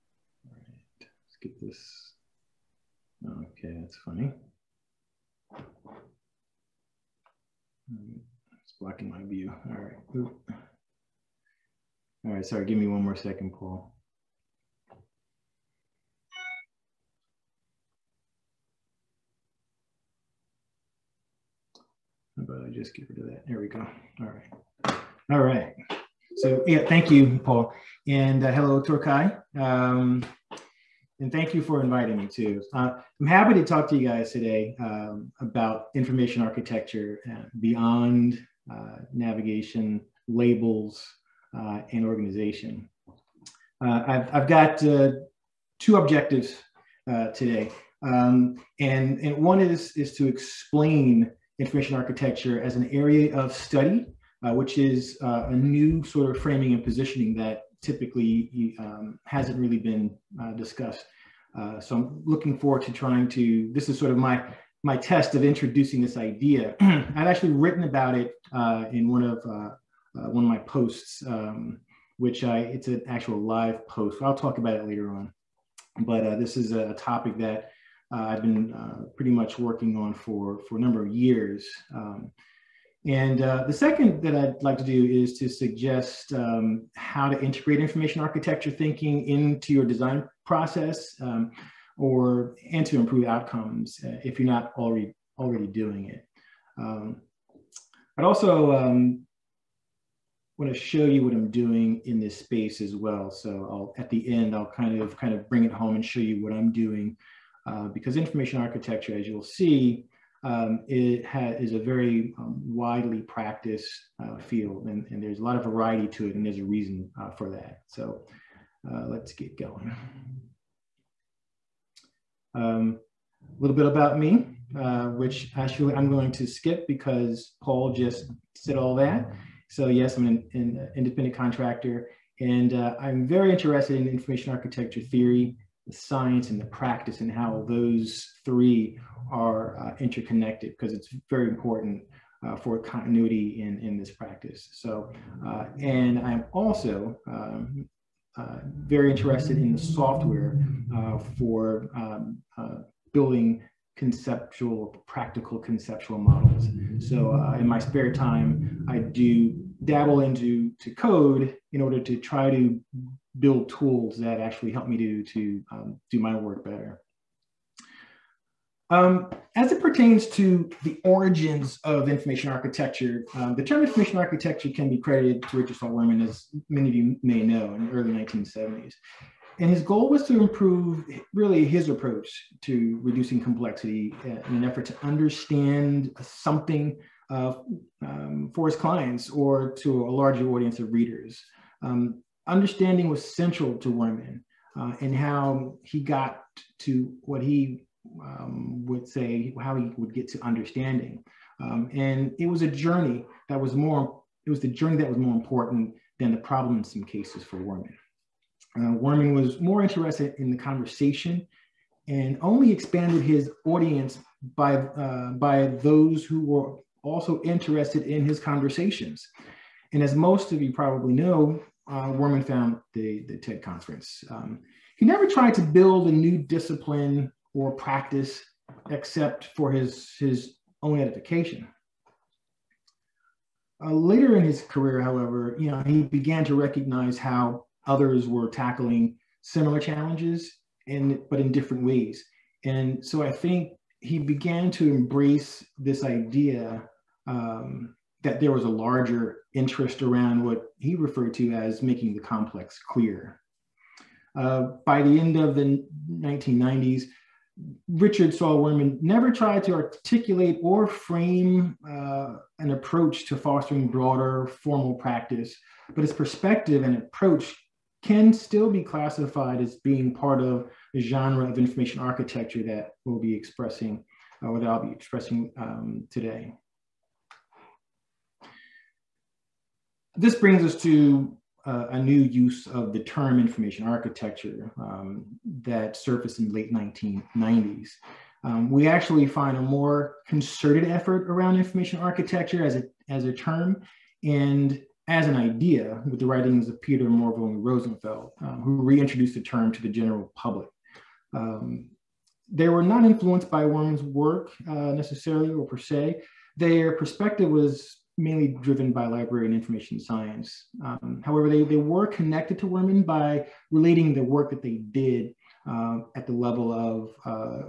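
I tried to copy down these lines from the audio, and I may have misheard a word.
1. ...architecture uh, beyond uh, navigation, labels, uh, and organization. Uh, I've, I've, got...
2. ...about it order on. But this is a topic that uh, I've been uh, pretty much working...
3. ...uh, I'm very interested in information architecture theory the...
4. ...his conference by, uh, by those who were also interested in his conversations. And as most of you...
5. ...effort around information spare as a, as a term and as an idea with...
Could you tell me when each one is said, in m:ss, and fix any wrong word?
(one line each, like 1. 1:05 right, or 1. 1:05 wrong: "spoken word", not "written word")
1. 0:36 right
2. 1:14 wrong: "later", not "order"
3. 2:12 right
4. 3:33 wrong: "audience", not "conference"
5. 4:50 wrong: "architecture", not "spare".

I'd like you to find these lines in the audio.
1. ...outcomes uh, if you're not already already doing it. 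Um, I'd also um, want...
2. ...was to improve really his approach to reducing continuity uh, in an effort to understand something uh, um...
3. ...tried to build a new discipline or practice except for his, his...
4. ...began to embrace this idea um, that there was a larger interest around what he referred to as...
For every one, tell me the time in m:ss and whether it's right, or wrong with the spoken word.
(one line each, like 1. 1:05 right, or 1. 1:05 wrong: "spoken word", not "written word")
1. 1:33 right
2. 3:00 wrong: "complexity", not "continuity"
3. 3:45 right
4. 4:04 right.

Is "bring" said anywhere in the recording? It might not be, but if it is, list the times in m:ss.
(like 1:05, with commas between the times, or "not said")
1:45, 4:40.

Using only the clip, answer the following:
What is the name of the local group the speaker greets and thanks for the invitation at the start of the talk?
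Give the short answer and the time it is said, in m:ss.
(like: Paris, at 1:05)
TorCHI, at 0:28.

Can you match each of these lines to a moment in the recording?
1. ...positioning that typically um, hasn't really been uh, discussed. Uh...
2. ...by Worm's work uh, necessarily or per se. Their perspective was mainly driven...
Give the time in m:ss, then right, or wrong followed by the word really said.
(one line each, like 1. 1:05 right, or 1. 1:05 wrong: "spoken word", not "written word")
1. 0:56 right
2. 5:03 right.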